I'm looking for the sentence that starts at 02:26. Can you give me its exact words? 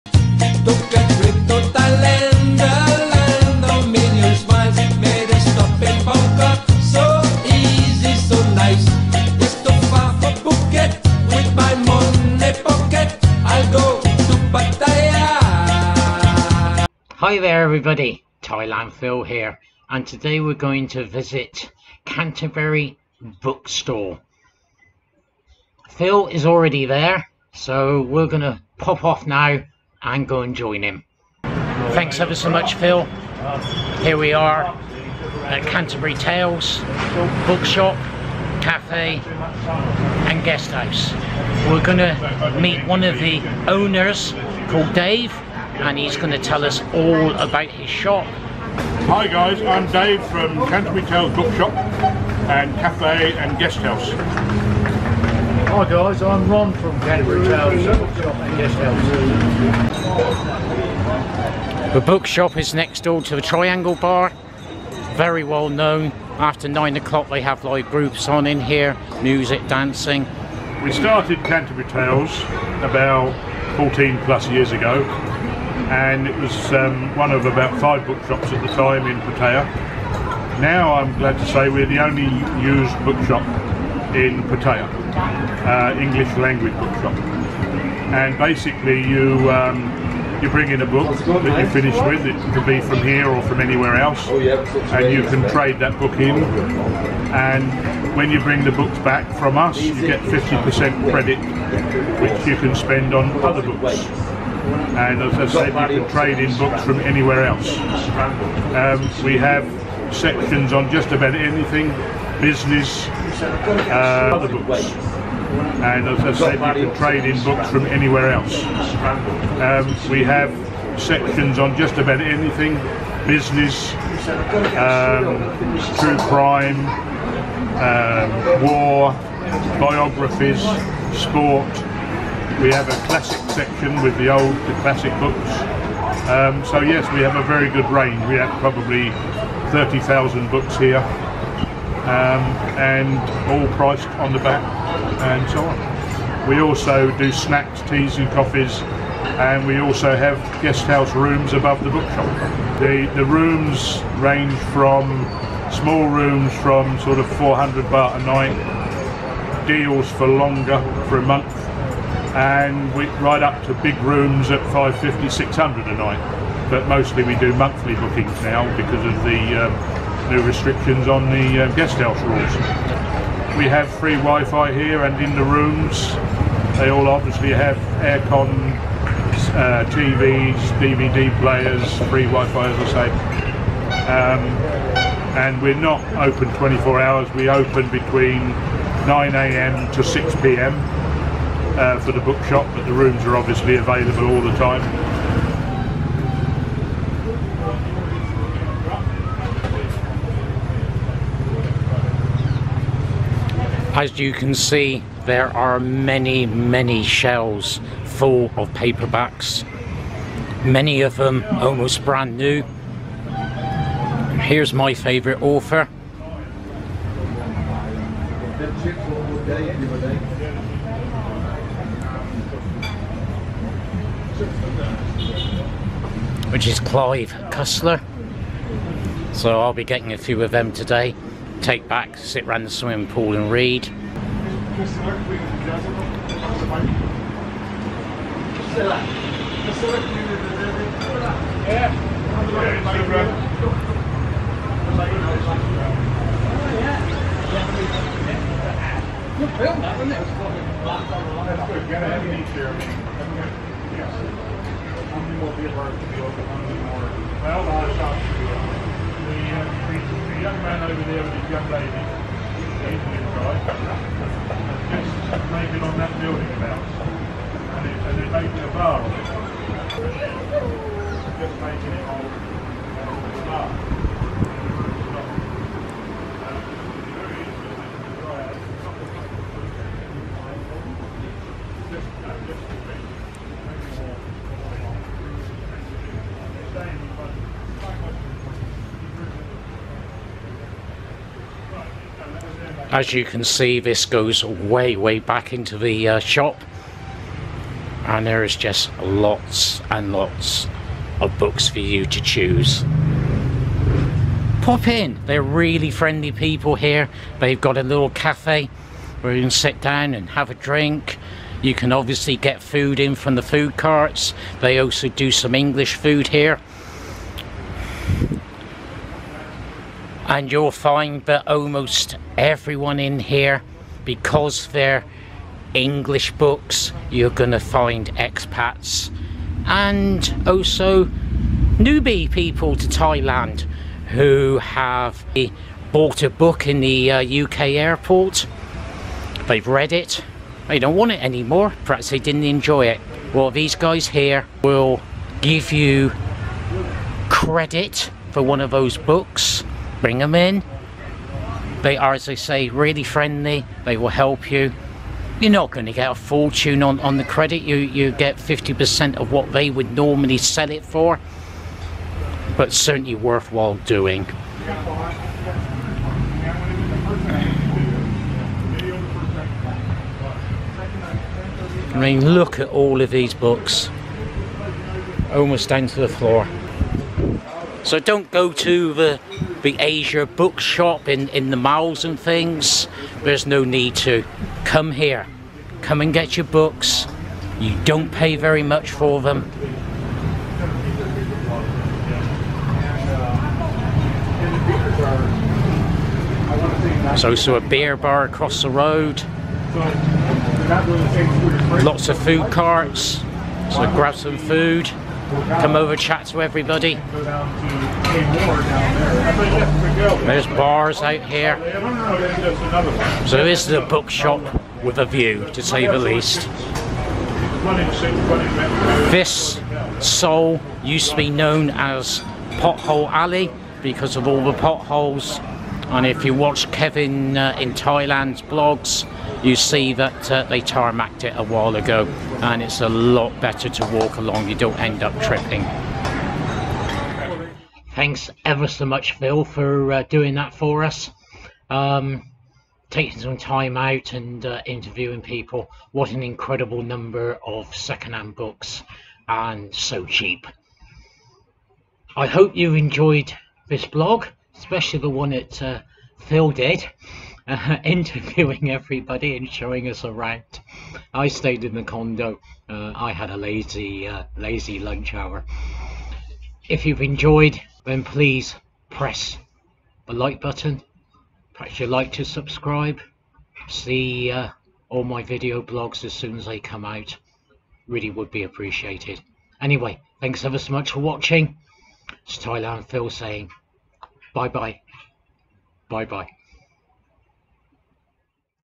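We also do snacks, teas and coffees and we also have guest house rooms above the bookshop.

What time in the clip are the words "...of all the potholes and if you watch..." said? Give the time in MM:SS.
07:04.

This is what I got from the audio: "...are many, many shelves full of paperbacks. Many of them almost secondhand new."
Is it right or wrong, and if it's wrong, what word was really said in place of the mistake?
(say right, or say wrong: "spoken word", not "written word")
wrong: "brand", not "secondhand".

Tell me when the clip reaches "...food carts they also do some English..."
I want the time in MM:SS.
05:13.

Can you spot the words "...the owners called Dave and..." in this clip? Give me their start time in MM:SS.
00:43.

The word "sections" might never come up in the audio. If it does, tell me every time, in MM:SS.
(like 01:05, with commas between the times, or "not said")
01:50, 02:01, 02:13.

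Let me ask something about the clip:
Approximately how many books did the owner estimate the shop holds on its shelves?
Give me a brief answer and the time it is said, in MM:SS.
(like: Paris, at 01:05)
30,000, at 02:19.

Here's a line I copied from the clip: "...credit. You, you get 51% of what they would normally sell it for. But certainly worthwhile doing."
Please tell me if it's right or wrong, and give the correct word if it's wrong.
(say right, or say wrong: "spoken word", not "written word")
wrong: "50", not "51".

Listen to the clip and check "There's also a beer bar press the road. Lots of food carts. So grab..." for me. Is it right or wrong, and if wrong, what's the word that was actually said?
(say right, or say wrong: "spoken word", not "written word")
wrong: "across", not "press".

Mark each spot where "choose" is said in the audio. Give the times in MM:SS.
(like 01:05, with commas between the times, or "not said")
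05:02.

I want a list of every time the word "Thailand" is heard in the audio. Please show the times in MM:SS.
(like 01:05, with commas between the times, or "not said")
00:18, 05:32, 07:07, 08:02.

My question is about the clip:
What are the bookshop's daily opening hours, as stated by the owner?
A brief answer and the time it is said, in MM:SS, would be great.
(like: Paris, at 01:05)
9 a.m. to 6 p.m., at 03:09.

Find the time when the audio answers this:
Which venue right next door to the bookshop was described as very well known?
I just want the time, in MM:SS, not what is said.
01:03.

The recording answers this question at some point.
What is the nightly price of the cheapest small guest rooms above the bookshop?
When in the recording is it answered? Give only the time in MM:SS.
02:37.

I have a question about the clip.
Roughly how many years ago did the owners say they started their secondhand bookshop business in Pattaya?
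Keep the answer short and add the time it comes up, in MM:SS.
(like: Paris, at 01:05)
14, at 01:13.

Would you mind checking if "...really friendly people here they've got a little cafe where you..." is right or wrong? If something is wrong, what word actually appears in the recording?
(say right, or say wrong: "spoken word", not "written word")
right.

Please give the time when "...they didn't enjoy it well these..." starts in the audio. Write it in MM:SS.
05:42.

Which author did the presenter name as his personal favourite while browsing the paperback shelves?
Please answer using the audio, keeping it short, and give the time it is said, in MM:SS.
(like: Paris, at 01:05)
Clive Cussler, at 03:46.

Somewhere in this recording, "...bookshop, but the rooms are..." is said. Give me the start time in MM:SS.
03:12.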